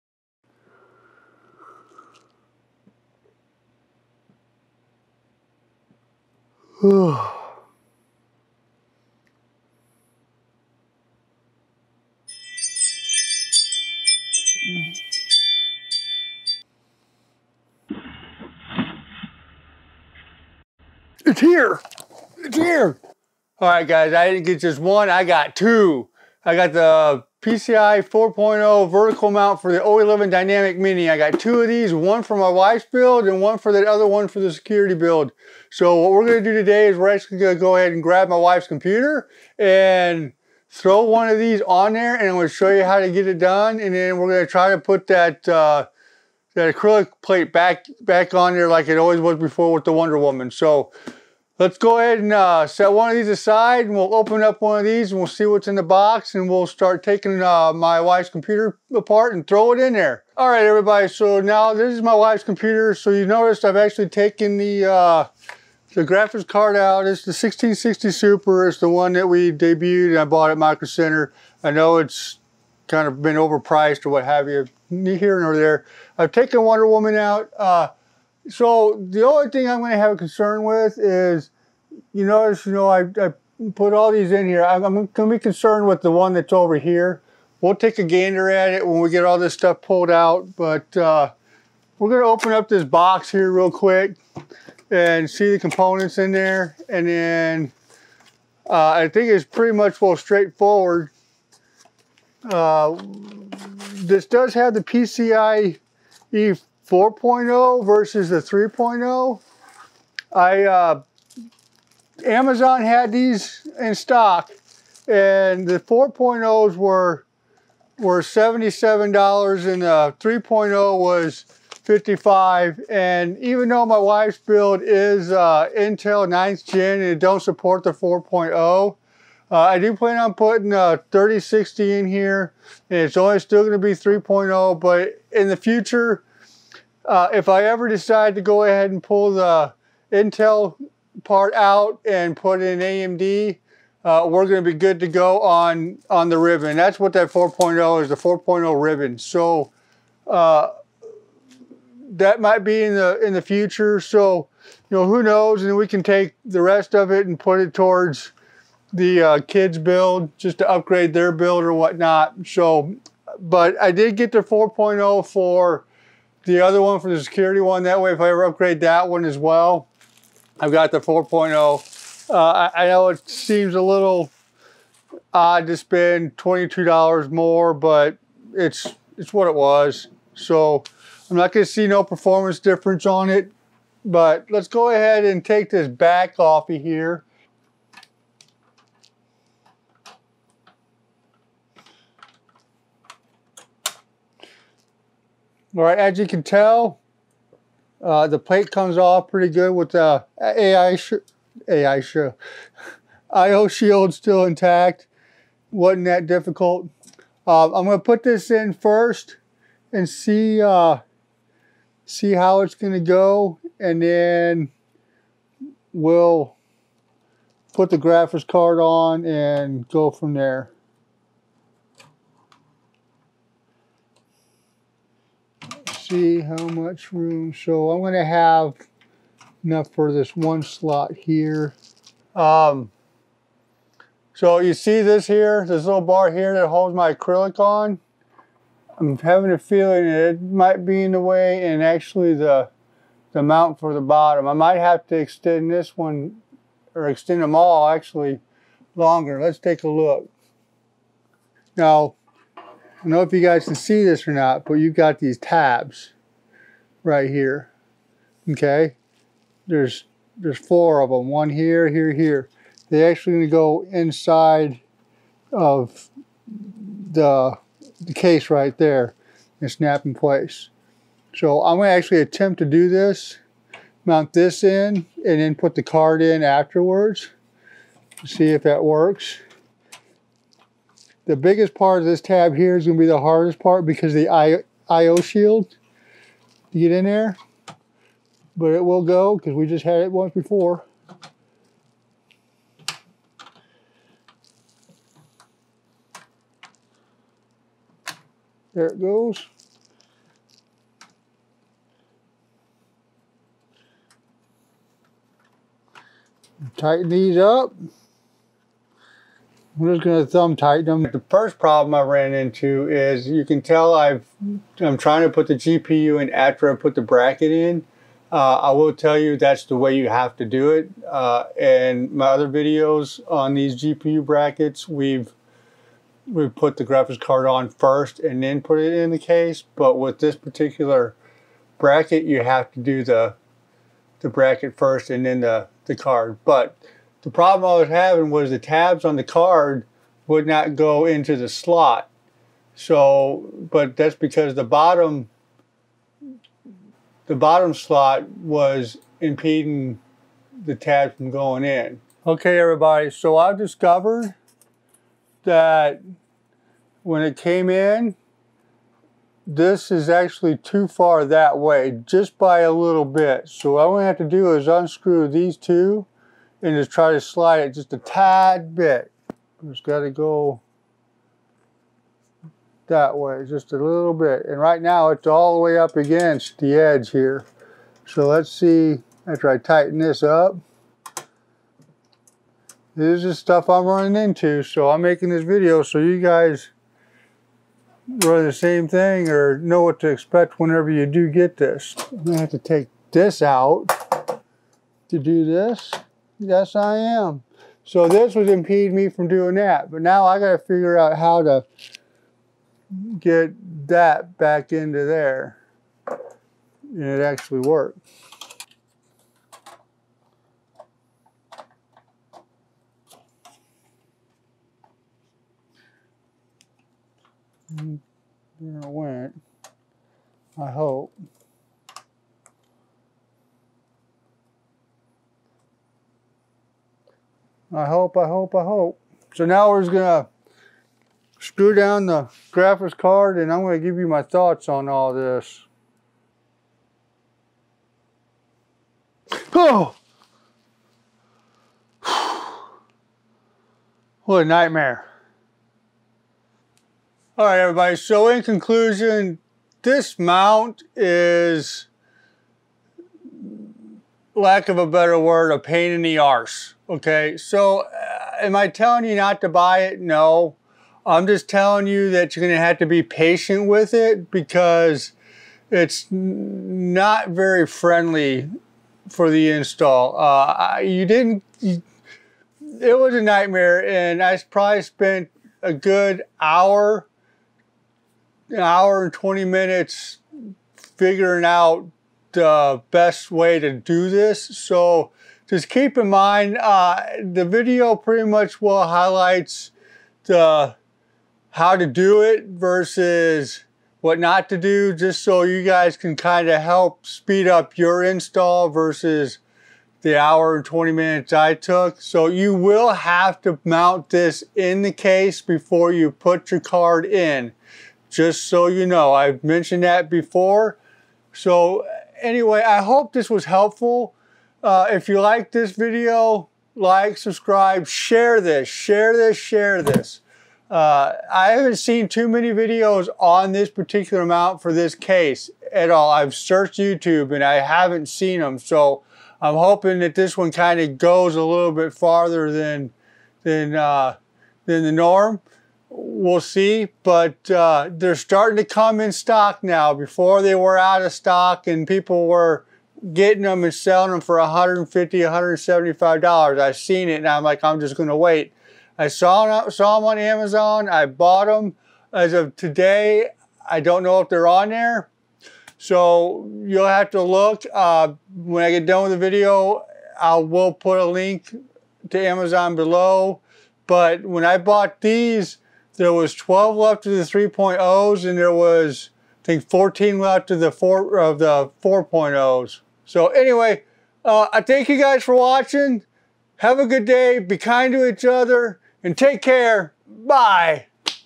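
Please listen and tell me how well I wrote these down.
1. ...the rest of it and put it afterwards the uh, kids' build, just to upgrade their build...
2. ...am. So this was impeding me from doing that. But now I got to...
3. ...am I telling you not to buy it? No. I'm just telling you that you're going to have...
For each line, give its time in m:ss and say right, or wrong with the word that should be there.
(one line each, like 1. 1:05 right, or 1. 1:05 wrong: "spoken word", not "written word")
1. 2:36 wrong: "towards", not "afterwards"
2. 6:36 right
3. 7:38 right.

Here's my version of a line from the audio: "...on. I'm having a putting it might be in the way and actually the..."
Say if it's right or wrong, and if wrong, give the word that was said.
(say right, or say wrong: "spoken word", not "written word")
wrong: "feeling", not "putting".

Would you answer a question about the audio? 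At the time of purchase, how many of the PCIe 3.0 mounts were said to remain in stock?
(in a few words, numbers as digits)
12.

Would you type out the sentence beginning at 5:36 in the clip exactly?
But the problem I was having was the tabs on the card would not go into the slot.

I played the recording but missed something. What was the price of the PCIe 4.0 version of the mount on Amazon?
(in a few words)
$77.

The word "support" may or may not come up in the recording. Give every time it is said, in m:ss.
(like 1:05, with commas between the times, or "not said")
2:07.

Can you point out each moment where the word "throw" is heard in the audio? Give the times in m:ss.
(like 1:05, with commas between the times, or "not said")
0:40, 0:59.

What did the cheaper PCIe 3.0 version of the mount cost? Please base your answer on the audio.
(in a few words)
$55.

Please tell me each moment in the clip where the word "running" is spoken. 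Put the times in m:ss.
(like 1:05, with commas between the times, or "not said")
6:23.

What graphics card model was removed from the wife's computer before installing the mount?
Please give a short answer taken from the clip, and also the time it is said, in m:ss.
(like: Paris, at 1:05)
1660 Super, at 1:07.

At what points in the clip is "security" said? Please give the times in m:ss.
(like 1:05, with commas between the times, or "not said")
0:34, 2:47.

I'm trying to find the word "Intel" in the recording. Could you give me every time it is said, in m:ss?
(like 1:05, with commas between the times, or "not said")
2:05, 2:20.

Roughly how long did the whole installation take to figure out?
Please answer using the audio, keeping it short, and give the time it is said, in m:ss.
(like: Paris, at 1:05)
an hour and 20 minutes, at 7:58.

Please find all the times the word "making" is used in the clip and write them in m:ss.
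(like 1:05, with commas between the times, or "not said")
6:25.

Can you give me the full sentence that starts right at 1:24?
I'm, I'm going to be concerned with the one that's over here.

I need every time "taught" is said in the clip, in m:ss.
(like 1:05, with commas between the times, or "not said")
not said.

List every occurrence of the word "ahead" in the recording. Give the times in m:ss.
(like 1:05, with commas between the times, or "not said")
0:37, 0:51, 2:18, 3:04.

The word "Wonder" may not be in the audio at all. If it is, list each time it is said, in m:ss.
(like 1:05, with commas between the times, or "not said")
0:49, 1:16.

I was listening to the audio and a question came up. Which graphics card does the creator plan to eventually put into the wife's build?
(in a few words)
3060.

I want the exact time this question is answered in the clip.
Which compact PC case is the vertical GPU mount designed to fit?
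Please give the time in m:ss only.
0:29.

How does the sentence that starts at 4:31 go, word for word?
So I'm going to actually attempt to do this, mount this in, and then put the card in afterwards.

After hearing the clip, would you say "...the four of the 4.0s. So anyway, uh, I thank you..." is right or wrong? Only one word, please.
right.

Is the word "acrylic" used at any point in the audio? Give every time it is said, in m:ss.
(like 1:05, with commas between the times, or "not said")
0:46, 3:57.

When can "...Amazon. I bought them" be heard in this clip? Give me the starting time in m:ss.
9:10.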